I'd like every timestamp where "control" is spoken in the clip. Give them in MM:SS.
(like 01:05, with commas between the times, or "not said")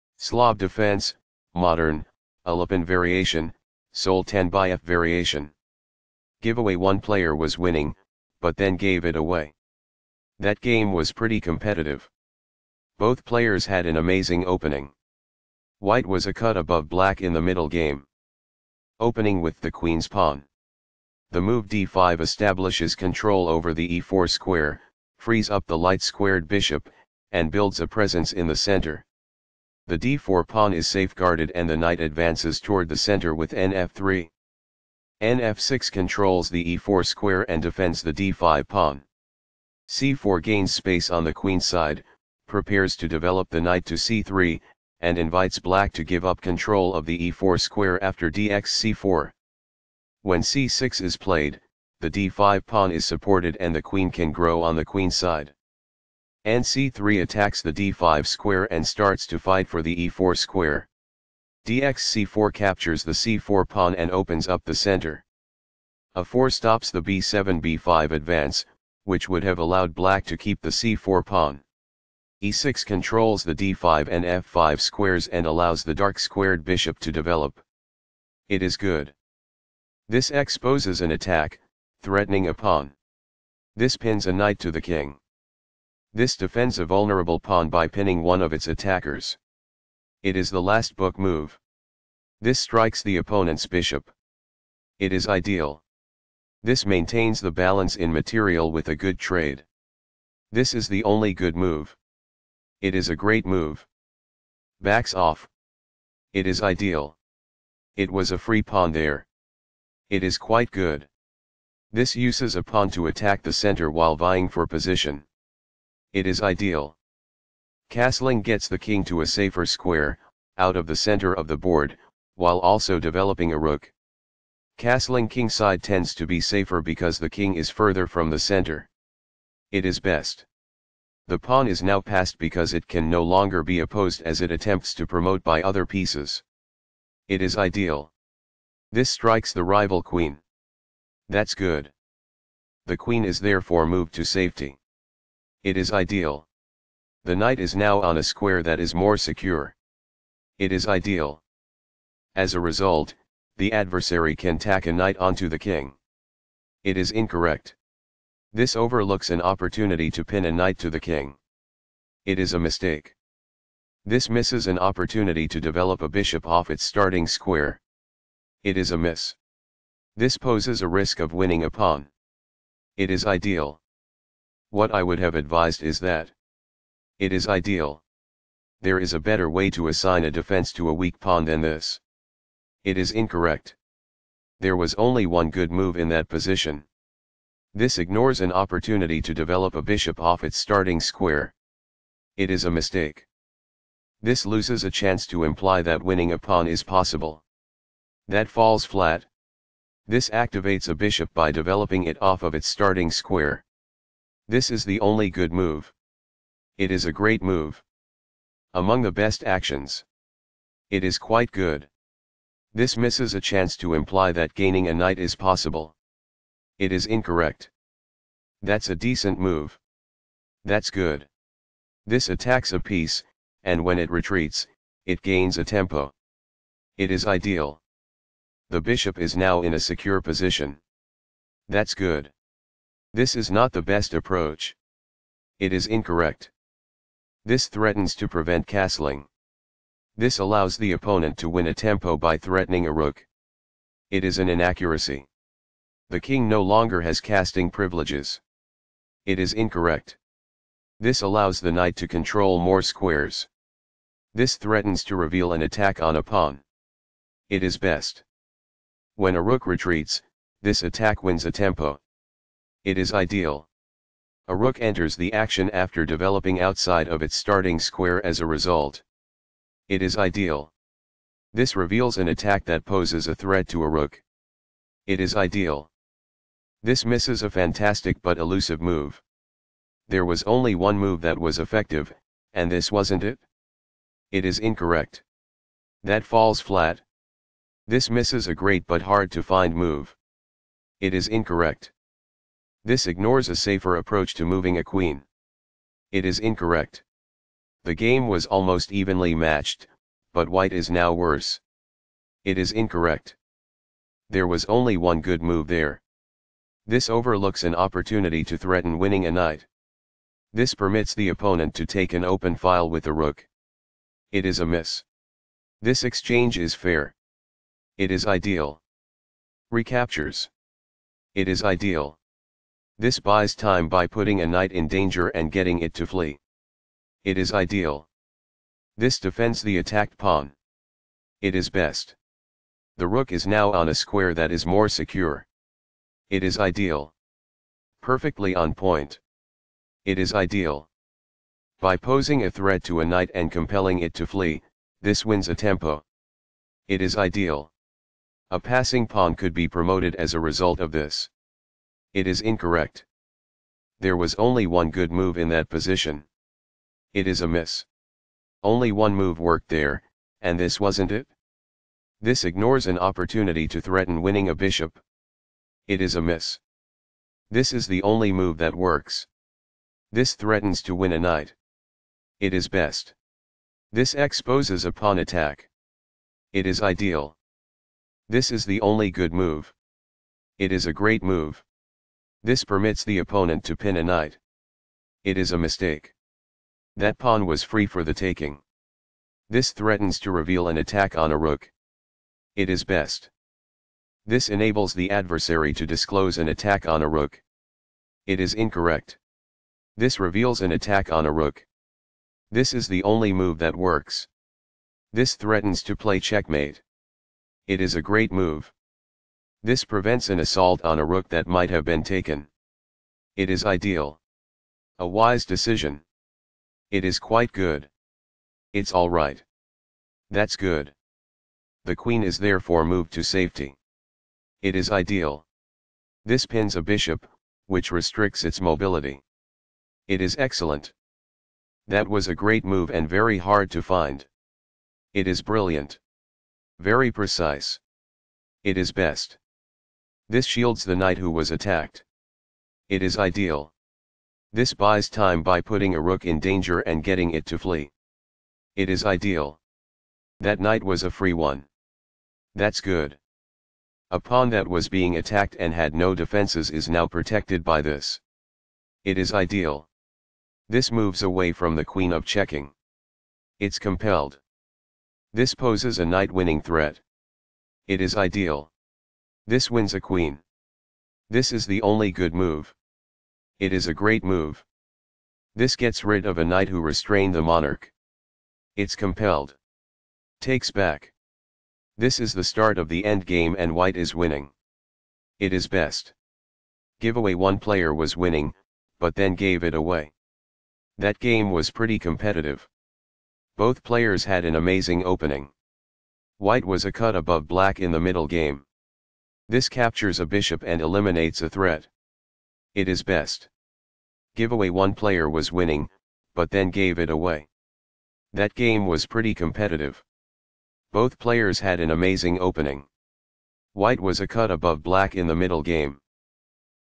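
00:22, 00:35, 00:46, 01:12, 04:12.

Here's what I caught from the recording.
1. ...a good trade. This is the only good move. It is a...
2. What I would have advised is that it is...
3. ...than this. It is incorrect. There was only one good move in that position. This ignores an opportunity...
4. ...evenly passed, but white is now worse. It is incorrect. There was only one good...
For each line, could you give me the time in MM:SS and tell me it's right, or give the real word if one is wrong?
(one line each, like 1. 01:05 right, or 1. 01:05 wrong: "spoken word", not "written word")
1. 01:38 right
2. 02:54 right
3. 03:01 right
4. 04:58 wrong: "matched", not "passed".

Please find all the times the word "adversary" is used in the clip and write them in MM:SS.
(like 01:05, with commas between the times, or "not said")
02:33, 06:35.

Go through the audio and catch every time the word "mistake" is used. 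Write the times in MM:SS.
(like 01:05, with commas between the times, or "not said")
02:42, 03:12, 06:25.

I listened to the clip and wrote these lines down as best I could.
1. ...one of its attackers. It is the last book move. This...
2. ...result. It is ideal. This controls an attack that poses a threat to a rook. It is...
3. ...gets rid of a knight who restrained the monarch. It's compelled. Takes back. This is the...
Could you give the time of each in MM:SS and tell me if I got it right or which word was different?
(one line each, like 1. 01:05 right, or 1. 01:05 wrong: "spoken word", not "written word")
1. 01:28 right
2. 04:28 wrong: "reveals", not "controls"
3. 07:55 right.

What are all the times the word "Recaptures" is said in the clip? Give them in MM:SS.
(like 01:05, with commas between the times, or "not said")
05:19.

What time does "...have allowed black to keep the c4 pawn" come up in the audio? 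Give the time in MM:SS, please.
01:09.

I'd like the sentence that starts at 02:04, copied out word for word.
Castling kingside tends to be safer because the king is further from the center.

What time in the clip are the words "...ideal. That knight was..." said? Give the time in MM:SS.
07:29.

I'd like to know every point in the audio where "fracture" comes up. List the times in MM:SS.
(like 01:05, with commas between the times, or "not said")
not said.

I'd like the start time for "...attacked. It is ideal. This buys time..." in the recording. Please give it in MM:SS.
07:21.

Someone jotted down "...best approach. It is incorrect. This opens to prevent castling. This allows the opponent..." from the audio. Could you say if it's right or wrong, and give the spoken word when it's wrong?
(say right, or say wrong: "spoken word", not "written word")
wrong: "threatens", not "opens".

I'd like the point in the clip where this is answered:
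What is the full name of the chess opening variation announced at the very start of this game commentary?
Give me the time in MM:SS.
00:03.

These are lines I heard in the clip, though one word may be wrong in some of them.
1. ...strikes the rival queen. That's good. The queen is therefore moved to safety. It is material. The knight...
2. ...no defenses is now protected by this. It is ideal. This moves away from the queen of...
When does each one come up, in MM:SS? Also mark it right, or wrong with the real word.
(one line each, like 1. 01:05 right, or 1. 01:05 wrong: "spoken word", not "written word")
1. 02:19 wrong: "ideal", not "material"
2. 07:35 right.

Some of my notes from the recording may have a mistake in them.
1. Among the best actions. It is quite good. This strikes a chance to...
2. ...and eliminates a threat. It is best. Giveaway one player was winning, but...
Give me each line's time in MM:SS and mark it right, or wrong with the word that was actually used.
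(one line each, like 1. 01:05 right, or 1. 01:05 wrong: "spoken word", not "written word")
1. 03:28 wrong: "misses", not "strikes"
2. 08:20 right.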